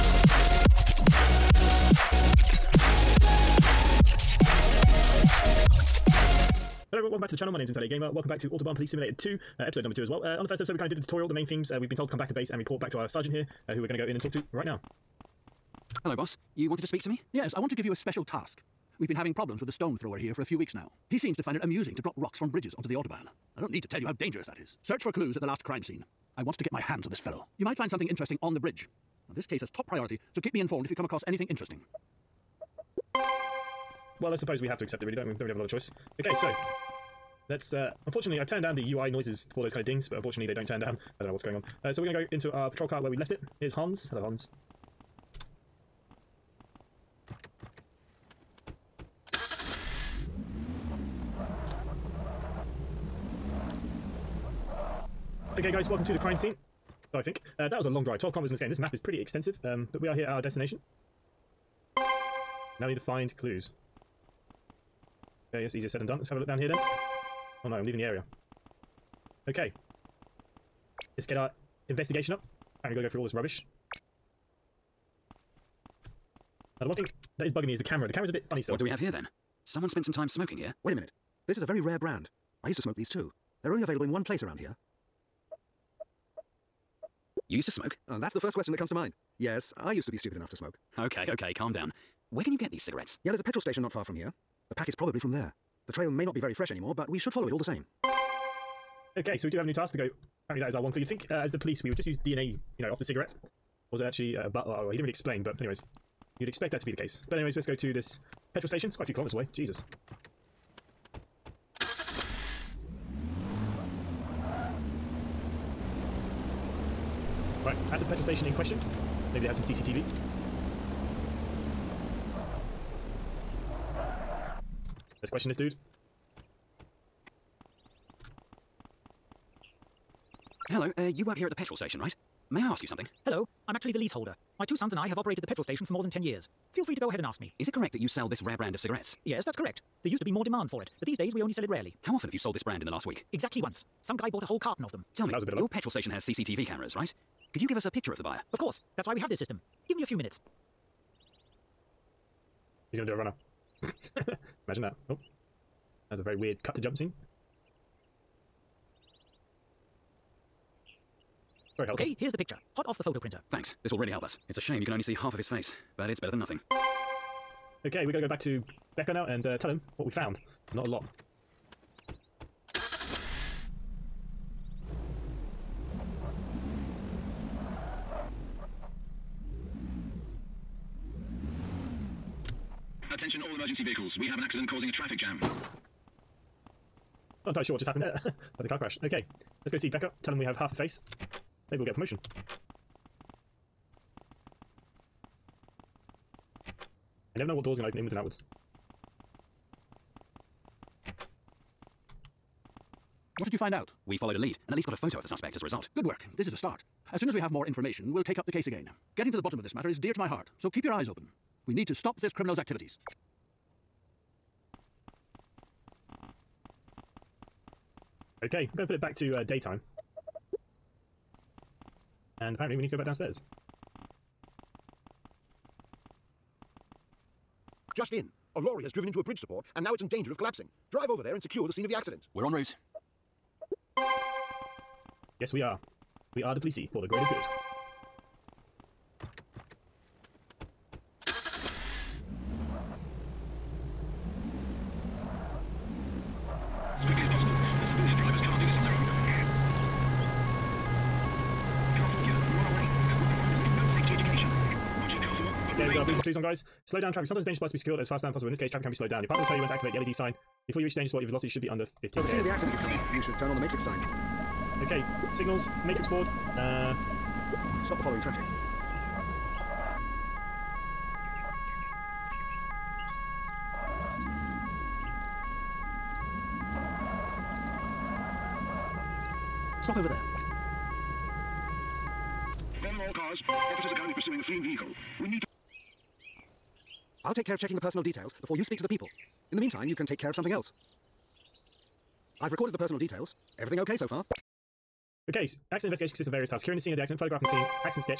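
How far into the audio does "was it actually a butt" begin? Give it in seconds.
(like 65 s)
103 s.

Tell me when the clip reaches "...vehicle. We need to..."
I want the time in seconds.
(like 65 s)
284 s.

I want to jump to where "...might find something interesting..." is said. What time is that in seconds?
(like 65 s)
27 s.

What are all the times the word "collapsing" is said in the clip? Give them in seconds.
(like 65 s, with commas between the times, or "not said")
230 s.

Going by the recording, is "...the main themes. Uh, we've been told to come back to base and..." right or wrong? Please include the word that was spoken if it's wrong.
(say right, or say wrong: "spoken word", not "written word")
right.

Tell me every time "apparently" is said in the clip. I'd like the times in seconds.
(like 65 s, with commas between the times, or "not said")
100 s, 222 s.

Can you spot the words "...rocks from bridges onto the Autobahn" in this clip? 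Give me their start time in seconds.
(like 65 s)
22 s.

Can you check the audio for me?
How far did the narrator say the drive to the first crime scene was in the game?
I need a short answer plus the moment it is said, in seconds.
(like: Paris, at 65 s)
12 kilometers, at 58 s.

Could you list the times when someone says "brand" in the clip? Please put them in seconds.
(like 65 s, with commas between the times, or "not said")
81 s, 138 s, 142 s.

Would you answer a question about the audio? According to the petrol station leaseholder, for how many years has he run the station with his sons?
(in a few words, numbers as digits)
more than 10 years.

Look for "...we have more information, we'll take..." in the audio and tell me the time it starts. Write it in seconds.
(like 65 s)
207 s.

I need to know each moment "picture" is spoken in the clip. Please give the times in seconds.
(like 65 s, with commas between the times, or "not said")
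147 s, 162 s.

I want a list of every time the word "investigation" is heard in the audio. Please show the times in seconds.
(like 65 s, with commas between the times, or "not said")
71 s, 295 s.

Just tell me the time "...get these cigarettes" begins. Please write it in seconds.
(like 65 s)
92 s.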